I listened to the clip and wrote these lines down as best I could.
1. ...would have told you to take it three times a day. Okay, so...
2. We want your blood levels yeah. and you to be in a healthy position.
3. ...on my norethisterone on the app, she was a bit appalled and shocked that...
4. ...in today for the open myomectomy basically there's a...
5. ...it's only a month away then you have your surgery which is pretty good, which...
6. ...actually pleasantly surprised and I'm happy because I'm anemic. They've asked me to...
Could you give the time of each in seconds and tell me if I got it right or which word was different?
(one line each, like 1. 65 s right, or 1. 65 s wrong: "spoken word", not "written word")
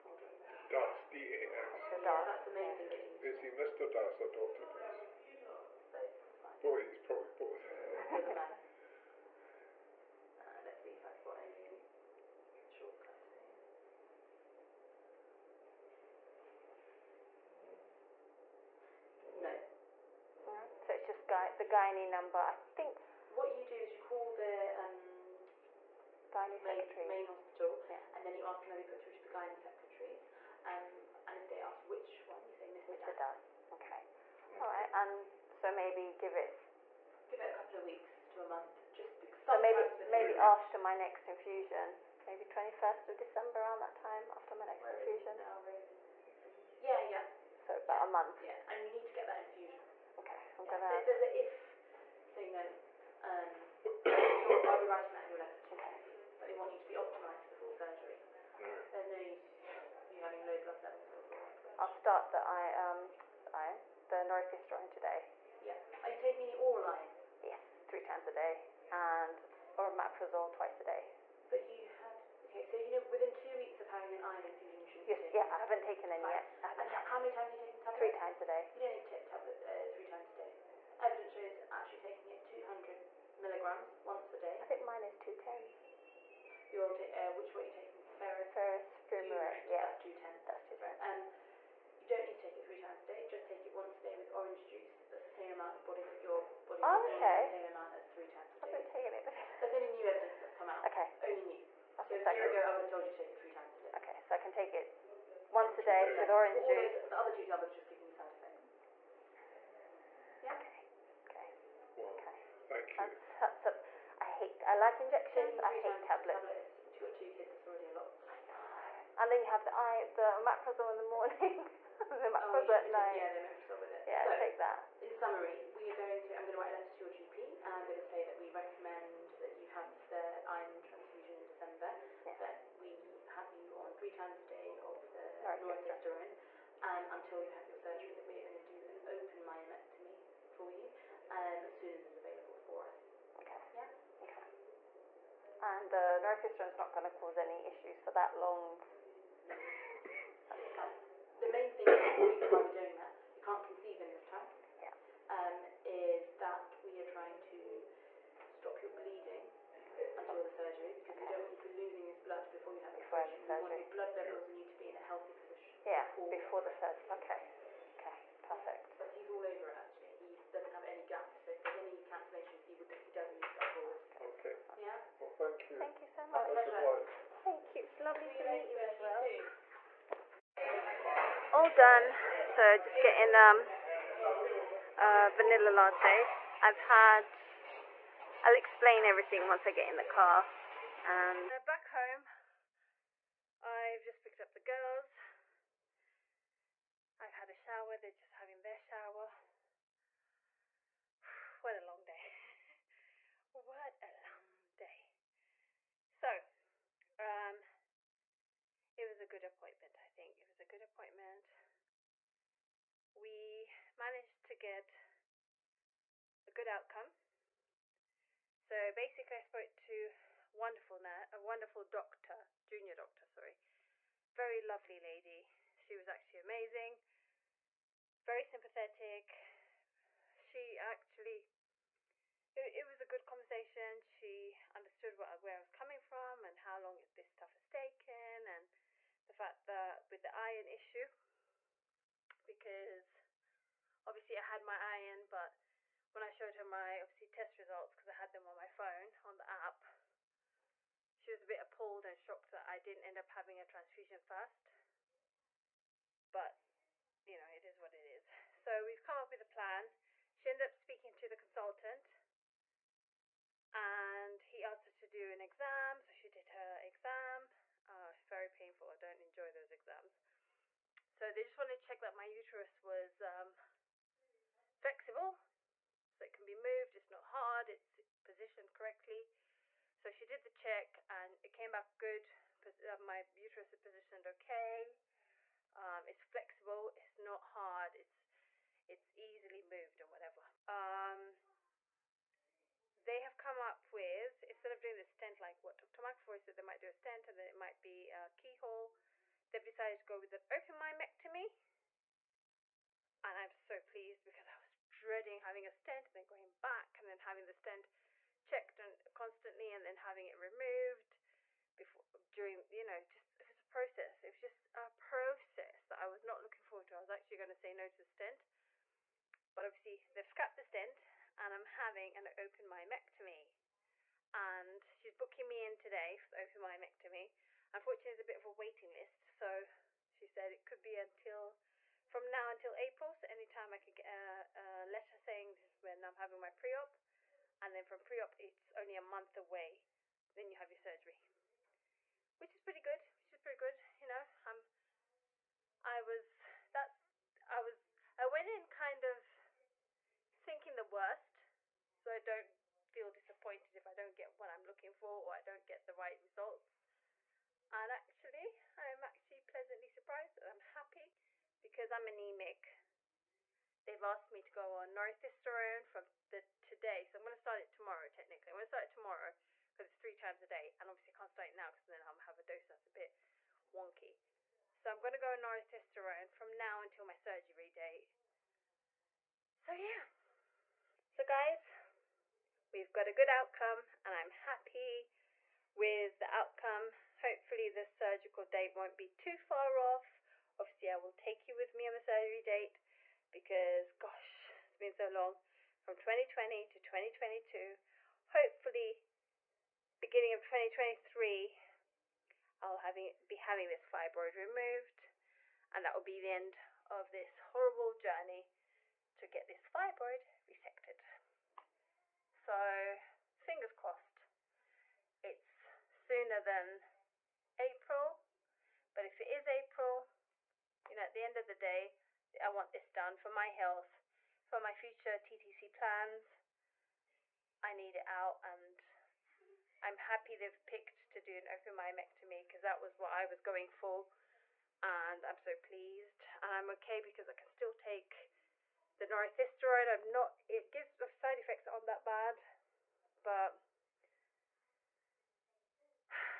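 1. 102 s right
2. 163 s right
3. 248 s wrong: "phone", not "norethisterone"
4. 325 s wrong: "unfortunately", not "basically"
5. 338 s right
6. 359 s right.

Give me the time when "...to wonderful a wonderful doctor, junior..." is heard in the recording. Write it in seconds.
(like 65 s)
219 s.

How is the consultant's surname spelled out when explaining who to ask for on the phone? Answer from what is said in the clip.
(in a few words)
D A S.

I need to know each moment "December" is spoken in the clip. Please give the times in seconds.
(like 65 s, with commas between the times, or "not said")
43 s, 131 s.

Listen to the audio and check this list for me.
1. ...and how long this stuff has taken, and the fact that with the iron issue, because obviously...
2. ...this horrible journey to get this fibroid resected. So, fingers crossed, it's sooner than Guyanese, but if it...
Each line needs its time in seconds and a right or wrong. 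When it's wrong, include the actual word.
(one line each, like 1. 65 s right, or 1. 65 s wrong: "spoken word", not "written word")
1. 236 s right
2. 407 s wrong: "April", not "Guyanese".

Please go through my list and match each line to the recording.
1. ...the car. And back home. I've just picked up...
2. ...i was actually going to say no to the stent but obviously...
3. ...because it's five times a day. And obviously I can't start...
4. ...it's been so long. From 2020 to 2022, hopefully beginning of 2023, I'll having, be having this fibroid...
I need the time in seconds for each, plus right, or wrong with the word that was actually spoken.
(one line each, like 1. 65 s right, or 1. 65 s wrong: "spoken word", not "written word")
1. 189 s right
2. 316 s right
3. 369 s wrong: "three", not "five"
4. 394 s right.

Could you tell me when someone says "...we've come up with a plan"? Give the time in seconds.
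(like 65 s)
258 s.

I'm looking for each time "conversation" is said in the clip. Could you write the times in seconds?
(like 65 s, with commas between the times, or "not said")
233 s.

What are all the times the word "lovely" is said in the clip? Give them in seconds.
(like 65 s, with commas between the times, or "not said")
177 s, 224 s.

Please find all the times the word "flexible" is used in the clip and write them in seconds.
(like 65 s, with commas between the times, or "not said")
274 s, 286 s.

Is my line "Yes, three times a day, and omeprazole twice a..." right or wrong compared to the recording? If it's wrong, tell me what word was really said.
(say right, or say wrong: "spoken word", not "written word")
right.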